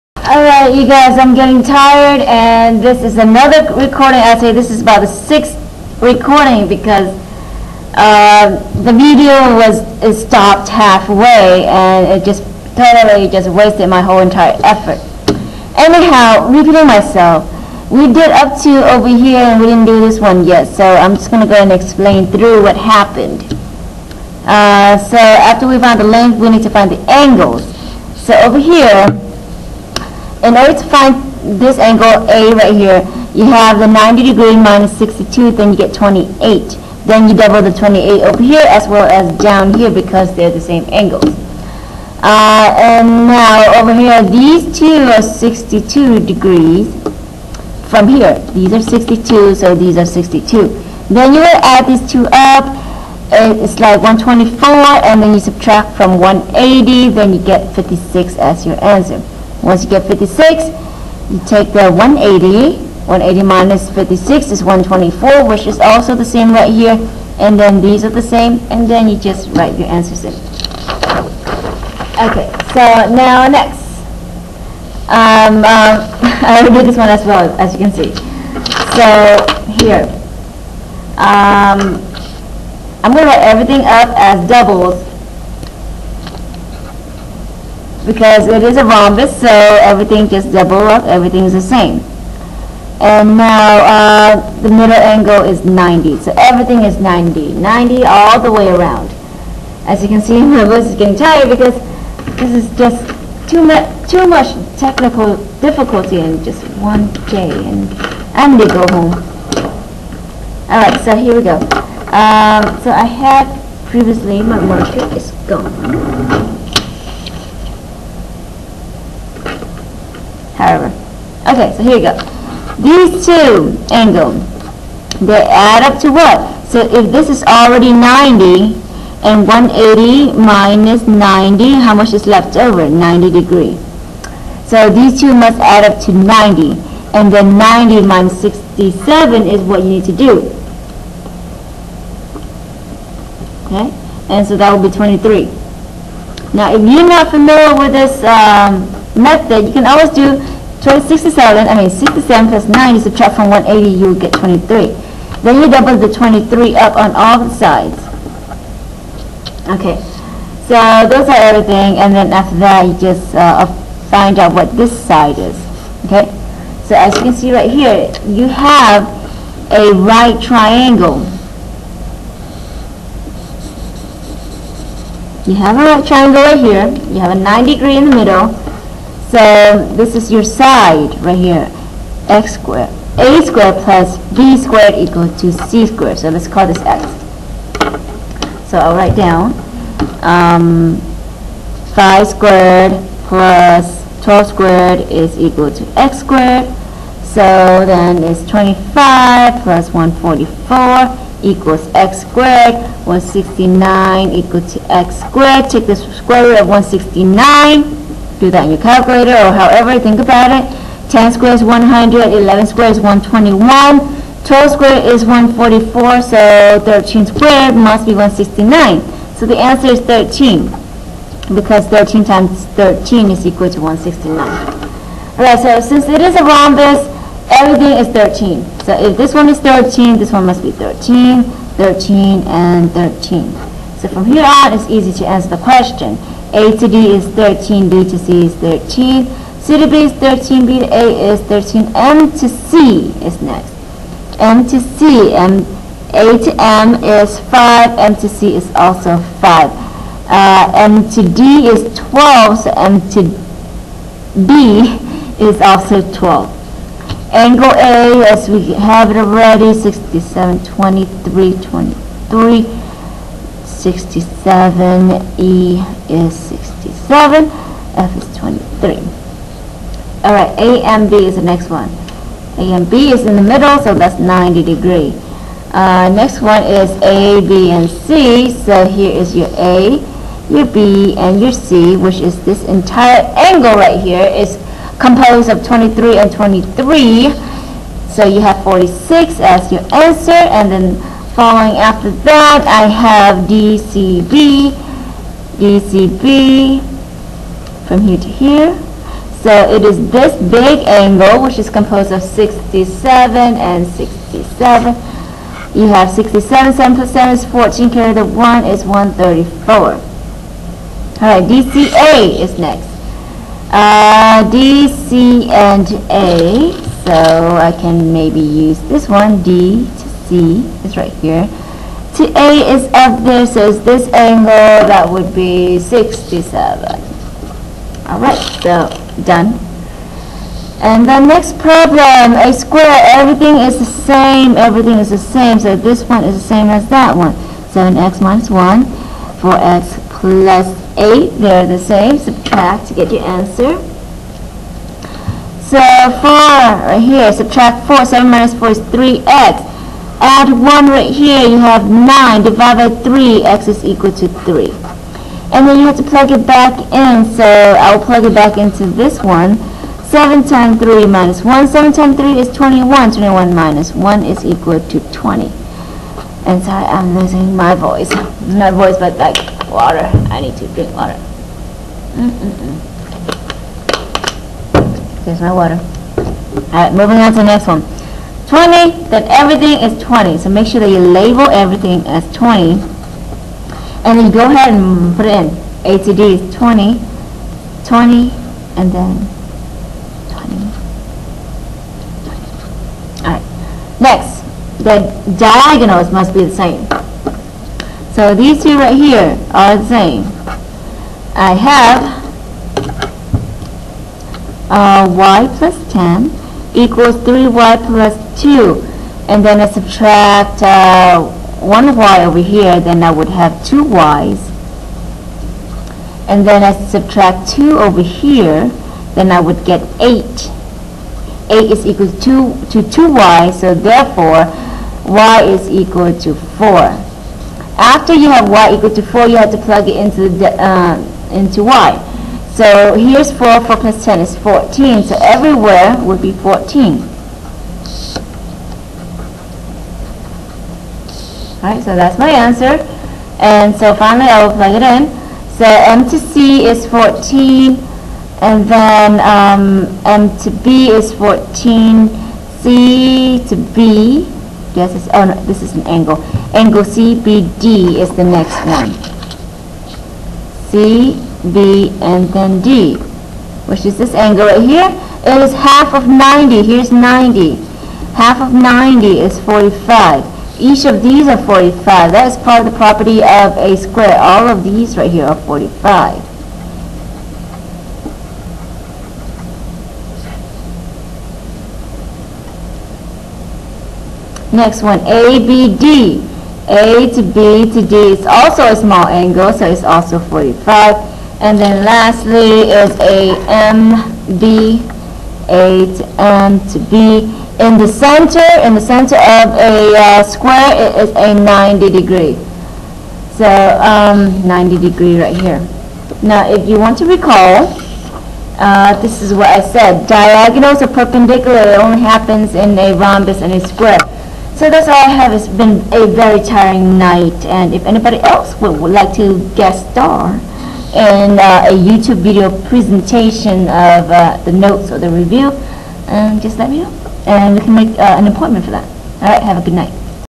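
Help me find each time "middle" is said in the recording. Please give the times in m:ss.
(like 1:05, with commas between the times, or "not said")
1:34, 2:58, 4:33.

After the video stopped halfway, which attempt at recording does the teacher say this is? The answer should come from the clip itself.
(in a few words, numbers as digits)
6th.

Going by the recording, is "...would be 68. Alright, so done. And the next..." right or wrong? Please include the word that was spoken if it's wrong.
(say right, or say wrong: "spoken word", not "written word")
wrong: "67", not "68".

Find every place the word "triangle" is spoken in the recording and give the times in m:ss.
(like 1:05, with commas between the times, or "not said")
2:50, 2:56.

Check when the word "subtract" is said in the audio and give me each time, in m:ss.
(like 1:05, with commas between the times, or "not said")
0:55, 2:33, 5:42, 5:47, 6:49, 6:56.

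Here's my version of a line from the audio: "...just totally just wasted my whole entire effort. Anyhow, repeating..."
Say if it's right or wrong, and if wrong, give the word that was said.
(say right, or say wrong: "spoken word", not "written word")
right.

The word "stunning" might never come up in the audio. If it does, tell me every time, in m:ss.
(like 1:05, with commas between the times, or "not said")
not said.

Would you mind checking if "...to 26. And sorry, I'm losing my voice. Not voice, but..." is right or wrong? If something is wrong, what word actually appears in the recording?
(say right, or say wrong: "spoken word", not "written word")
wrong: "20", not "26".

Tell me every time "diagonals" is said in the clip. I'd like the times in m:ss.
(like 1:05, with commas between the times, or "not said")
6:35, 8:30.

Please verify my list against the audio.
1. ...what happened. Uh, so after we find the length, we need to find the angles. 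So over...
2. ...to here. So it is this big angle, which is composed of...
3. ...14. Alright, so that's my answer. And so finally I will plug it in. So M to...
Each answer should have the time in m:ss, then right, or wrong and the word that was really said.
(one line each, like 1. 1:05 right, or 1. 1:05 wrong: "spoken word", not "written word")
1. 0:22 right
2. 4:58 right
3. 7:16 right.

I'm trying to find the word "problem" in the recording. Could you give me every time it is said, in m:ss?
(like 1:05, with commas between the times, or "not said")
5:31.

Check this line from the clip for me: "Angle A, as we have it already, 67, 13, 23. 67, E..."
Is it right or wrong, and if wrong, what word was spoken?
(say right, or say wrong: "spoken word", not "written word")
wrong: "23", not "13".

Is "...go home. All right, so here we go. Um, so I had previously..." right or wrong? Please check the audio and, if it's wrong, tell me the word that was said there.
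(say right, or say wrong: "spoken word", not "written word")
right.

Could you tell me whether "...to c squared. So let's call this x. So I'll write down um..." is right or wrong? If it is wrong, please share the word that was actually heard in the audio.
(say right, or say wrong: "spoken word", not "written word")
right.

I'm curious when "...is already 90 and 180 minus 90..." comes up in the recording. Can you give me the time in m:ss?
2:07.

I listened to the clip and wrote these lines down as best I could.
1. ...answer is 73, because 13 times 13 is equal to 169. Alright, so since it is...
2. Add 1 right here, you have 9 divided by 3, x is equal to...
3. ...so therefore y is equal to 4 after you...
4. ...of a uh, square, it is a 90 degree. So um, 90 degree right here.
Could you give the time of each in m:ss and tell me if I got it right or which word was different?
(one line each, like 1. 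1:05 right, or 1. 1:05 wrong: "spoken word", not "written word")
1. 3:39 wrong: "13", not "73"
2. 5:50 right
3. 7:03 right
4. 8:19 right.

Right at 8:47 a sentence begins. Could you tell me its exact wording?
And we can make uh, an appointment for that.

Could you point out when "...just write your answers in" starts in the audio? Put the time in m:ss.
1:09.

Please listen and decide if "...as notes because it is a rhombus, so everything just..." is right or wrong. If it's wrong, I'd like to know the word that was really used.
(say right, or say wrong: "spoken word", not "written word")
wrong: "doubles", not "notes".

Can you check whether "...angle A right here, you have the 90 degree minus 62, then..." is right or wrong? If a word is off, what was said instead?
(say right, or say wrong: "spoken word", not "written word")
right.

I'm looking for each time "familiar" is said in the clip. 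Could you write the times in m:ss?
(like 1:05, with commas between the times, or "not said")
2:27.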